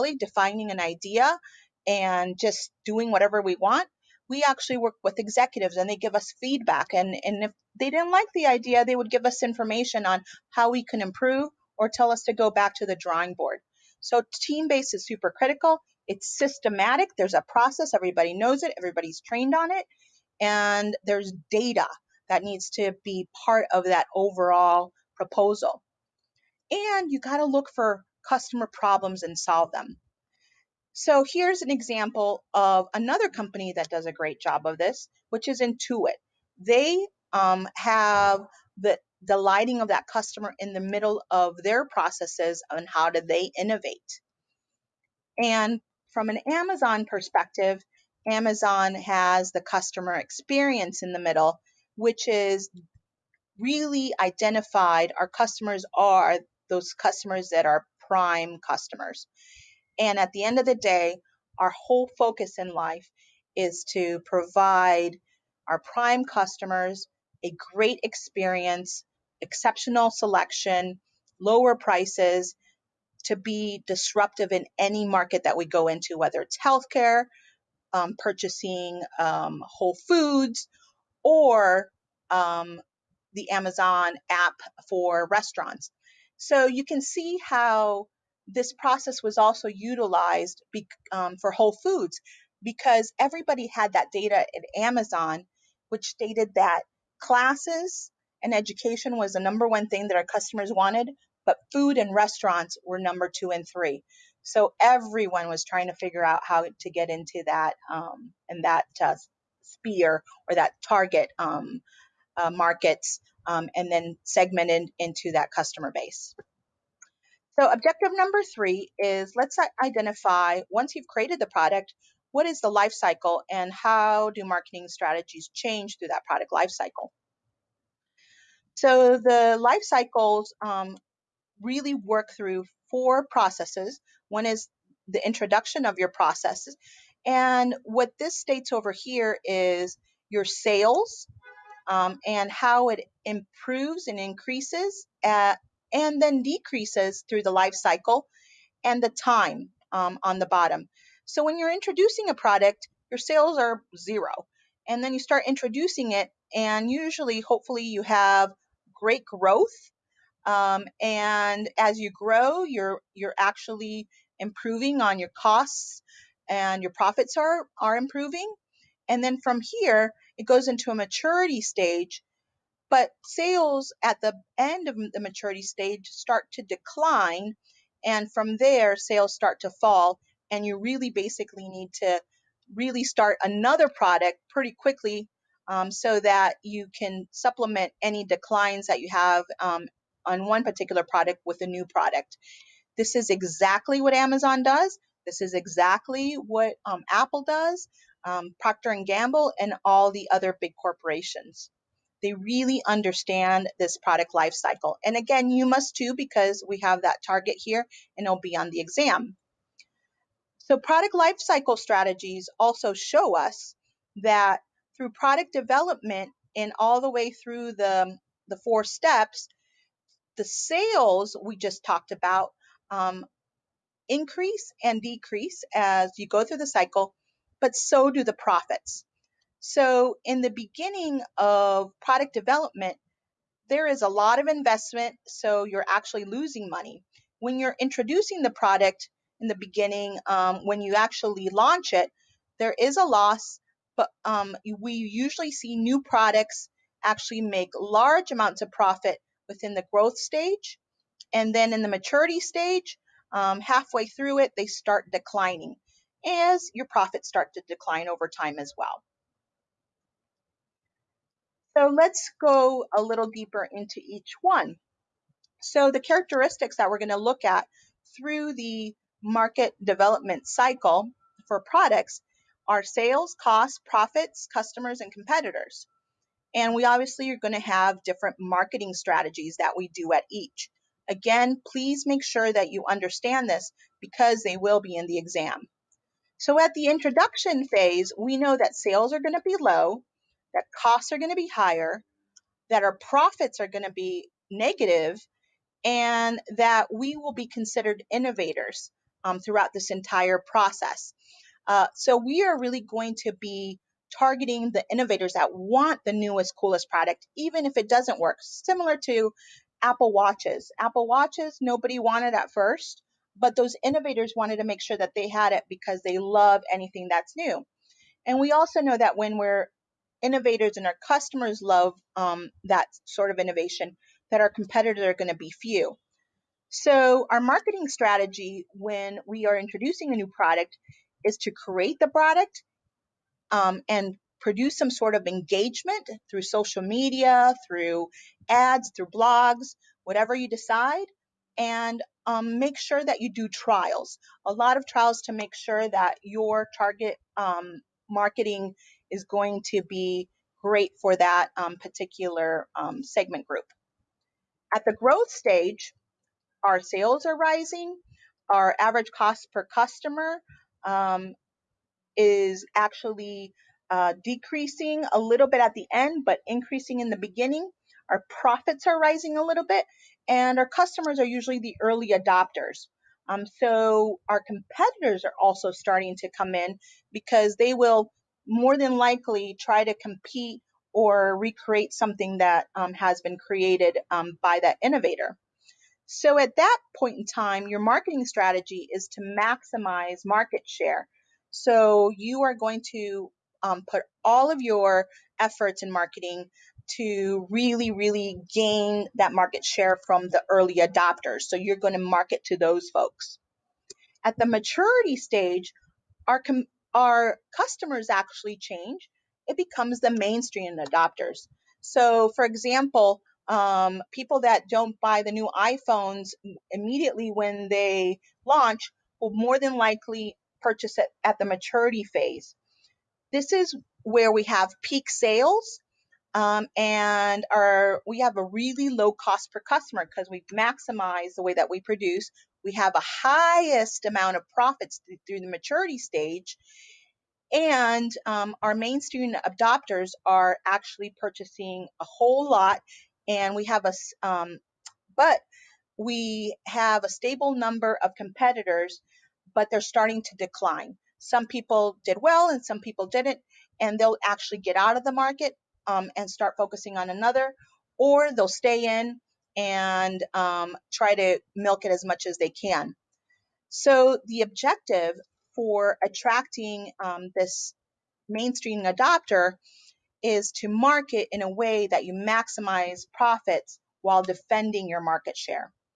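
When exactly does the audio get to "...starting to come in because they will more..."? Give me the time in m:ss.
6:15.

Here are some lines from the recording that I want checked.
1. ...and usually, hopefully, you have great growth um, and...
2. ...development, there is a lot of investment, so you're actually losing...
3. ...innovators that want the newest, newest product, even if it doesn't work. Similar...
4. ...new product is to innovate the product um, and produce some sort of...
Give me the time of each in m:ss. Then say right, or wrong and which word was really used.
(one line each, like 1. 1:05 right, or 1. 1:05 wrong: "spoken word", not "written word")
1. 2:36 right
2. 3:52 right
3. 5:04 wrong: "coolest", not "newest"
4. 5:30 wrong: "create", not "innovate".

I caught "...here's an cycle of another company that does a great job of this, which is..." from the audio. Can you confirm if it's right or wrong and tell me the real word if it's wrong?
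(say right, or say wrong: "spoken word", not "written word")
wrong: "example", not "cycle".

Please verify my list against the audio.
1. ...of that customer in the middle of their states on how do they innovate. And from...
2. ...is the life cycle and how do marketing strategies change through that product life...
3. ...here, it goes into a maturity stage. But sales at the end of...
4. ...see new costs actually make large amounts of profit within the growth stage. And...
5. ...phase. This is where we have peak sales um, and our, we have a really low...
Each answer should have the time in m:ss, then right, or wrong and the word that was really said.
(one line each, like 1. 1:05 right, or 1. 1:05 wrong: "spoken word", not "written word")
1. 0:39 wrong: "processes", not "states"
2. 2:02 right
3. 2:49 right
4. 4:05 wrong: "products", not "costs"
5. 7:02 right.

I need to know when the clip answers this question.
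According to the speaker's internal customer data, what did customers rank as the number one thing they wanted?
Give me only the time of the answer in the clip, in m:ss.
1:37.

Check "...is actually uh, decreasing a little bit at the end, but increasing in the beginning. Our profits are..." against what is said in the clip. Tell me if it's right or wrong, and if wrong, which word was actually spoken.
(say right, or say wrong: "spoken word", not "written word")
right.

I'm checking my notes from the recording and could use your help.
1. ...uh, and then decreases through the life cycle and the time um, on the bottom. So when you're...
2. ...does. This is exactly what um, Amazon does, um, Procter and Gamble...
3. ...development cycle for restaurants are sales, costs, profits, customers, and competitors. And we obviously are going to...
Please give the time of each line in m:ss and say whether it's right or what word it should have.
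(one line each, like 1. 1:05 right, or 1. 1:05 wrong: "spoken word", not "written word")
1. 2:25 right
2. 3:14 wrong: "Apple", not "Amazon"
3. 4:29 wrong: "products", not "restaurants".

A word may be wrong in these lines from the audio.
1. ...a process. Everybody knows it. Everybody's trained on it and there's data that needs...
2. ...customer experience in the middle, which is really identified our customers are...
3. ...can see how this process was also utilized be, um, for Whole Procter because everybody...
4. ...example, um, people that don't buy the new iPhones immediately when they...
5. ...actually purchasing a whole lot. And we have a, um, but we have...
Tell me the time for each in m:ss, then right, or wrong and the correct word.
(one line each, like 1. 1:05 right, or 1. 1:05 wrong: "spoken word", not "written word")
1. 0:17 right
2. 0:49 right
3. 1:26 wrong: "Foods", not "Procter"
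4. 6:52 right
5. 7:20 right.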